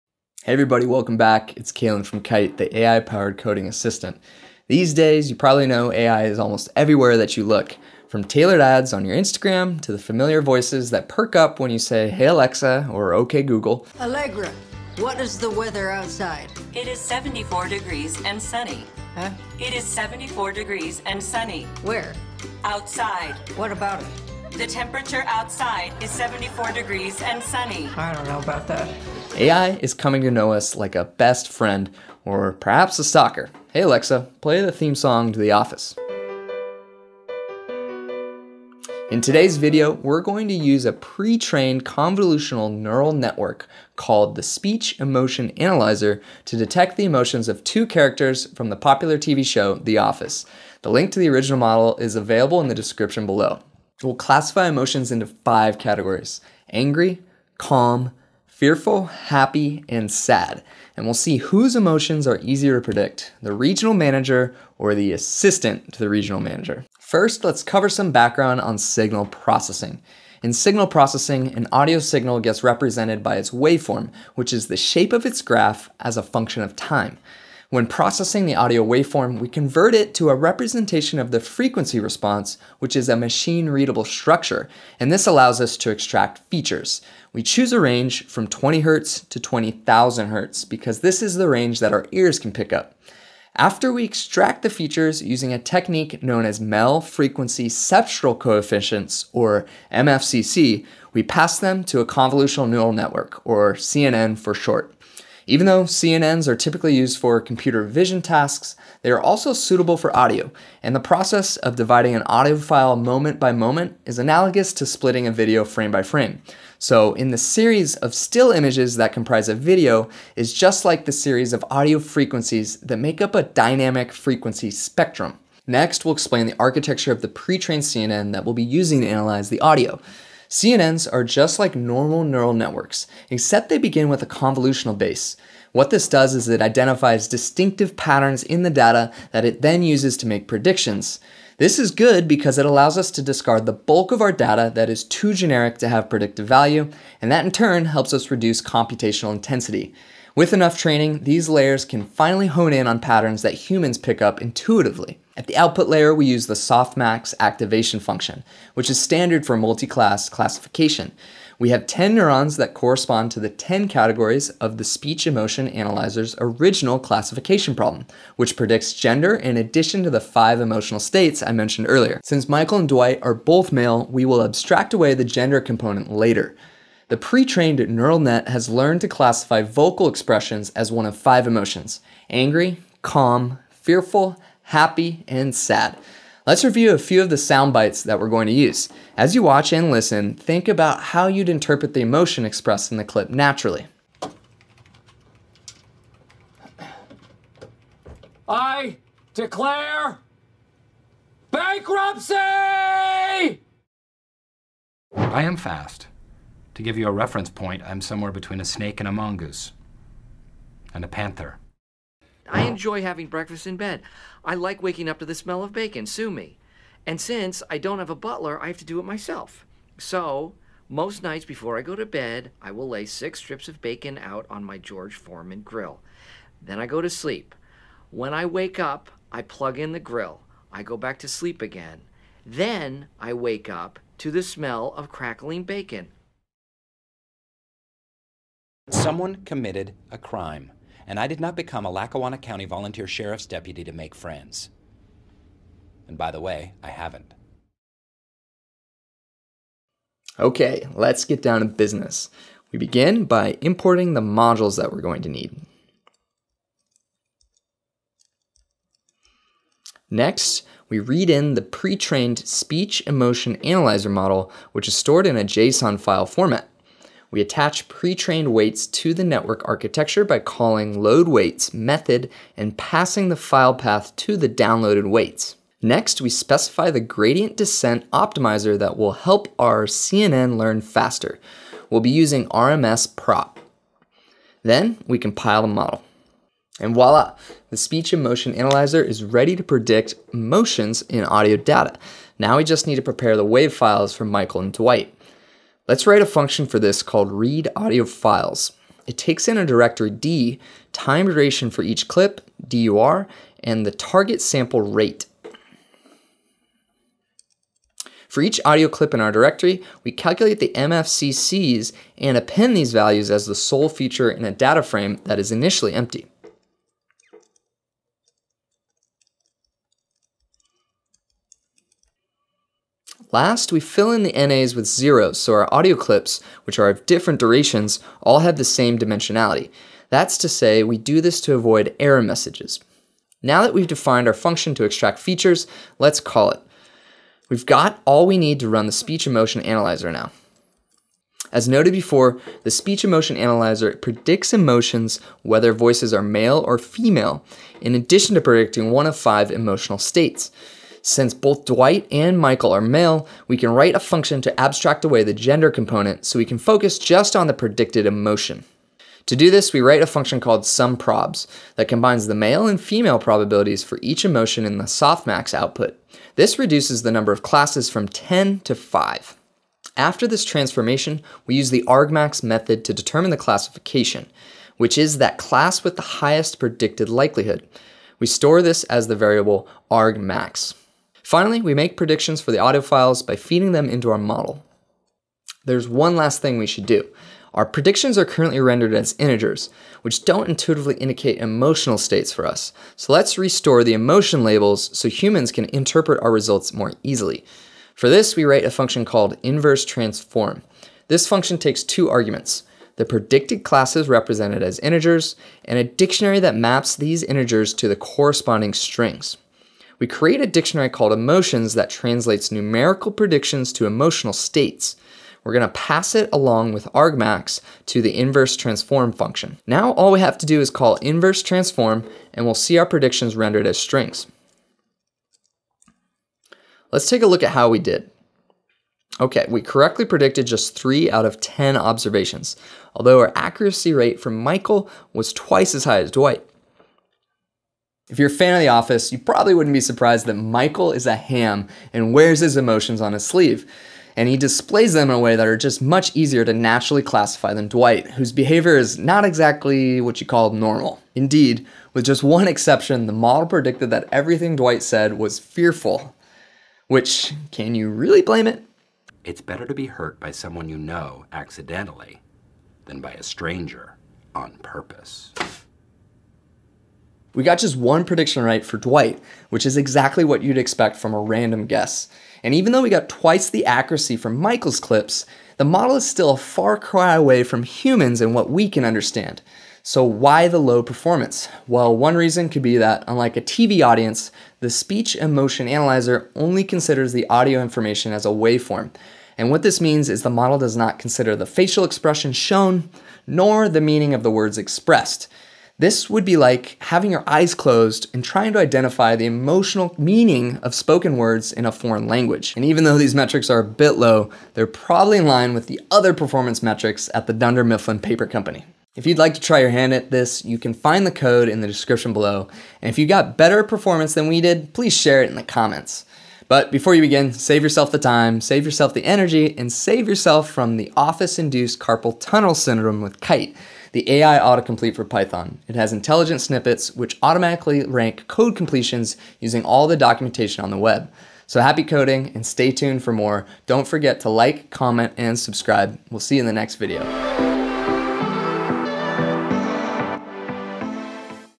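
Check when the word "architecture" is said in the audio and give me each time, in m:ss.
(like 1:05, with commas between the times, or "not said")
2:06, 4:29.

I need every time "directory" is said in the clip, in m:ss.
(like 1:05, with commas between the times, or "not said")
4:59, 5:09.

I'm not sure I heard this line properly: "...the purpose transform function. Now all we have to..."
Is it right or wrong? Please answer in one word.
wrong.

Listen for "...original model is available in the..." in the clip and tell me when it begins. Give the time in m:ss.
0:51.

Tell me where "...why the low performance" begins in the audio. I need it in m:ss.
8:00.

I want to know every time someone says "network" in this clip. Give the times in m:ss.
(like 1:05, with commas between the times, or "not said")
0:43, 1:42, 2:12, 4:29.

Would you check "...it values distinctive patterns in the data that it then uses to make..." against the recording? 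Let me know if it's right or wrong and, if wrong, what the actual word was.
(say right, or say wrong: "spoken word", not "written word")
wrong: "identifies", not "values".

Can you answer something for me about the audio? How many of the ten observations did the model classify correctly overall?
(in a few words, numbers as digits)
3.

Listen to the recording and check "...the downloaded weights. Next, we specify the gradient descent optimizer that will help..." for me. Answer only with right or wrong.
right.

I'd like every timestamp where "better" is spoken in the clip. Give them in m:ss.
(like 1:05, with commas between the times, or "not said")
7:39, 8:33.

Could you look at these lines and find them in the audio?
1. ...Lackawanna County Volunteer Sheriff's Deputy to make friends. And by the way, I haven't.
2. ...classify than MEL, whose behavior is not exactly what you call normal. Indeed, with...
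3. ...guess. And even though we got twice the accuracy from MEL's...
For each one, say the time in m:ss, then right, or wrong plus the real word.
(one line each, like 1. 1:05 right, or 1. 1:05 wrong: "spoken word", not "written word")
1. 4:01 right
2. 7:27 wrong: "Dwight", not "MEL"
3. 7:51 wrong: "Michael", not "MEL".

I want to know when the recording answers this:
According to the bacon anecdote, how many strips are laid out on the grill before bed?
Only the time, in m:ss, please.
3:43.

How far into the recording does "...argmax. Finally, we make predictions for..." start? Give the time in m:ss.
6:19.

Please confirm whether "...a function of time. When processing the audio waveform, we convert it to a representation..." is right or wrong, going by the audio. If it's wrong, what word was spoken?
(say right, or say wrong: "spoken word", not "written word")
right.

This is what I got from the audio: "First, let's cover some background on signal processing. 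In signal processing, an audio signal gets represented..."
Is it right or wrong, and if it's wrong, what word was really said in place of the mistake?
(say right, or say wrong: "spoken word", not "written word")
right.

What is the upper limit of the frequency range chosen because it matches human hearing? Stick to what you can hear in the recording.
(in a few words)
20,000 Hz.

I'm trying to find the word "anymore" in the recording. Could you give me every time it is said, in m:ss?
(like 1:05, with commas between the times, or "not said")
not said.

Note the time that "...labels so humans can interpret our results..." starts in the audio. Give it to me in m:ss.
6:34.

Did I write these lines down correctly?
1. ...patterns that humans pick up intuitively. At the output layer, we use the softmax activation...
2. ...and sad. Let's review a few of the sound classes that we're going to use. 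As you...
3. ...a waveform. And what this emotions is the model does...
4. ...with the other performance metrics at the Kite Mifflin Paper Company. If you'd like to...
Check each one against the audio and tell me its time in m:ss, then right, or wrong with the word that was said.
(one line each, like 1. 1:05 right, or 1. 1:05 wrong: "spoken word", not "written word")
1. 2:32 right
2. 3:05 wrong: "bites", not "classes"
3. 8:08 wrong: "means", not "emotions"
4. 8:25 wrong: "Dunder", not "Kite".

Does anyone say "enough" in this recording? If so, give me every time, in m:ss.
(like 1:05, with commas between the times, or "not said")
2:30.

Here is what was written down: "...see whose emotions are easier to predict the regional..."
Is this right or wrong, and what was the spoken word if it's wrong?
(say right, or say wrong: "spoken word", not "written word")
right.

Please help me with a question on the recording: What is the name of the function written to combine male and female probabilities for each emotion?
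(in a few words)
sumProbs.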